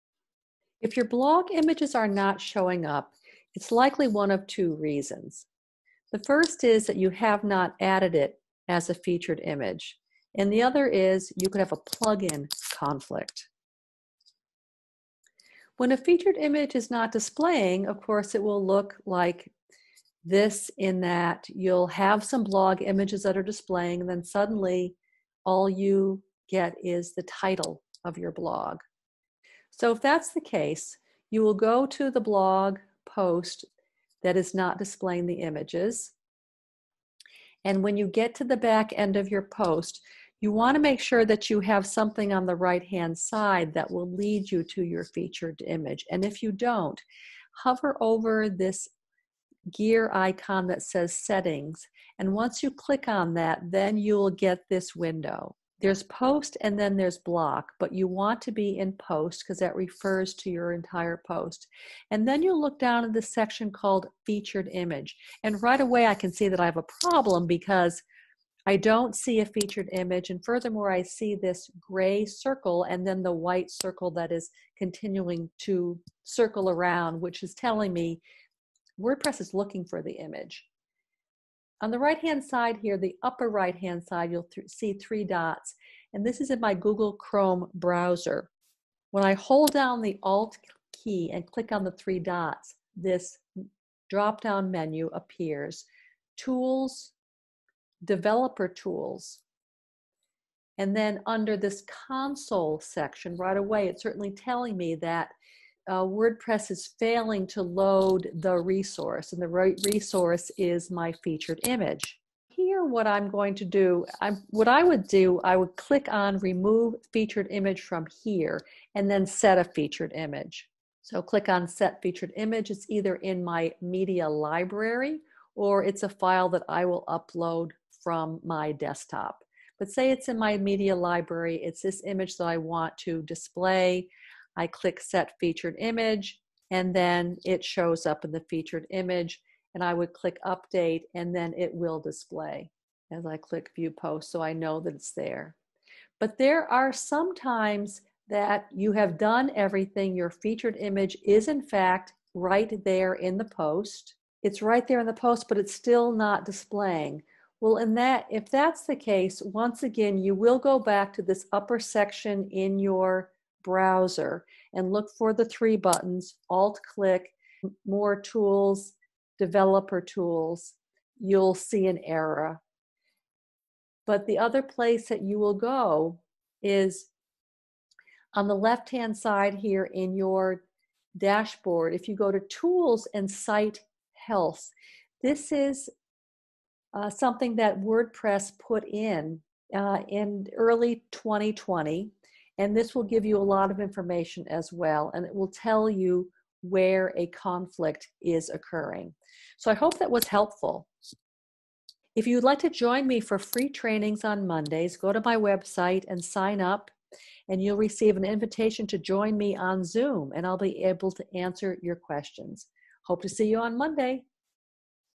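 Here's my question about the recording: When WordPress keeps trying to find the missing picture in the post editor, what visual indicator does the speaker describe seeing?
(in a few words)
Gray circle.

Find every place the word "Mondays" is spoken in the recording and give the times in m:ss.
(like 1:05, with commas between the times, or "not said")
3:24, 3:33.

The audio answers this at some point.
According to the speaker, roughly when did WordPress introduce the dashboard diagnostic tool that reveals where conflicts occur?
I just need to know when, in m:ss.
3:10.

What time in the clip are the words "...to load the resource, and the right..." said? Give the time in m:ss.
1:47.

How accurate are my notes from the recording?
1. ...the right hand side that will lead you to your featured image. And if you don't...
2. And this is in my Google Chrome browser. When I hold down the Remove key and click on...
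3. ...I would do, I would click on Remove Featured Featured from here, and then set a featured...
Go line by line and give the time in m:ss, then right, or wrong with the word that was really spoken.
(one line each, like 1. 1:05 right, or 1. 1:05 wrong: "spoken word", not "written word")
1. 0:42 right
2. 1:26 wrong: "Alt", not "Remove"
3. 1:54 wrong: "Image", not "Featured".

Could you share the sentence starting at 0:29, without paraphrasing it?
So if that's the case, you will go to the blog post that is not displaying the images.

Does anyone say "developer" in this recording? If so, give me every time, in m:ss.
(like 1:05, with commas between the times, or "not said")
1:38, 2:49.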